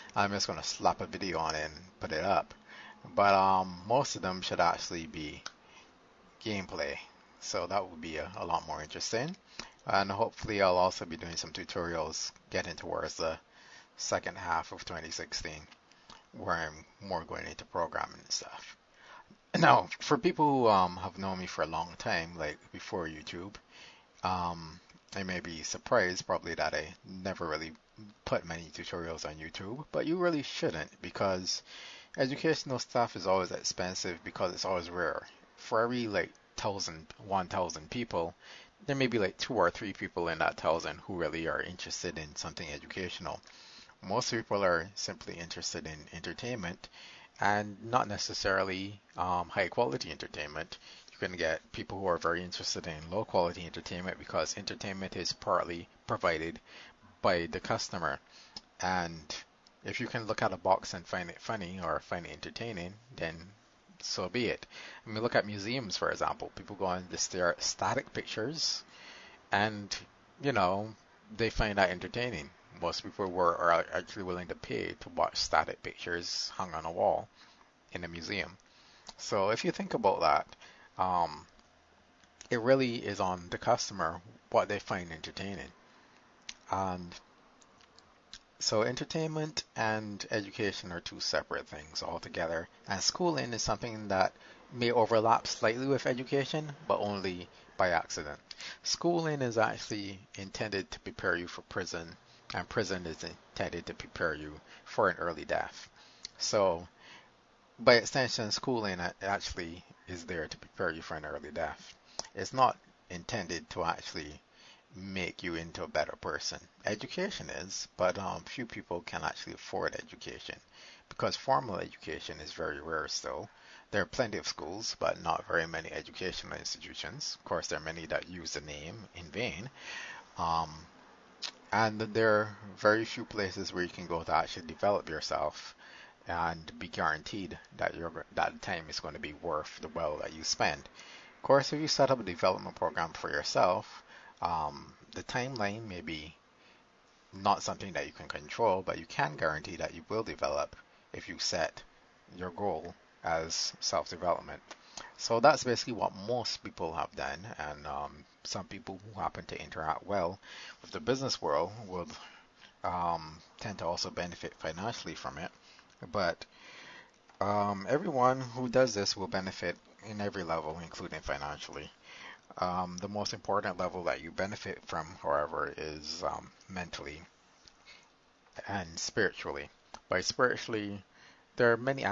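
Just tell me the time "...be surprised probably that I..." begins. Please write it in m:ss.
0:25.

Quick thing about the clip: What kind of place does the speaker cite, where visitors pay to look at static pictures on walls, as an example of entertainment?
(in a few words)
museums.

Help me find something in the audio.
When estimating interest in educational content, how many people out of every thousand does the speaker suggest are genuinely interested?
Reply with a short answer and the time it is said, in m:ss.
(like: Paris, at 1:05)
two or three, at 0:39.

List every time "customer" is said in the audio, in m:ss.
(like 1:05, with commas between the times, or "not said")
0:57, 1:23.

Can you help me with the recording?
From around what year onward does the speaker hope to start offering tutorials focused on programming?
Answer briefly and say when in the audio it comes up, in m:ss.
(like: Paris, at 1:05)
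2016, at 0:14.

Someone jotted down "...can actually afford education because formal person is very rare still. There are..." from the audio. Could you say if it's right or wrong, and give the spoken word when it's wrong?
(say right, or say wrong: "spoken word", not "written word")
wrong: "education", not "person".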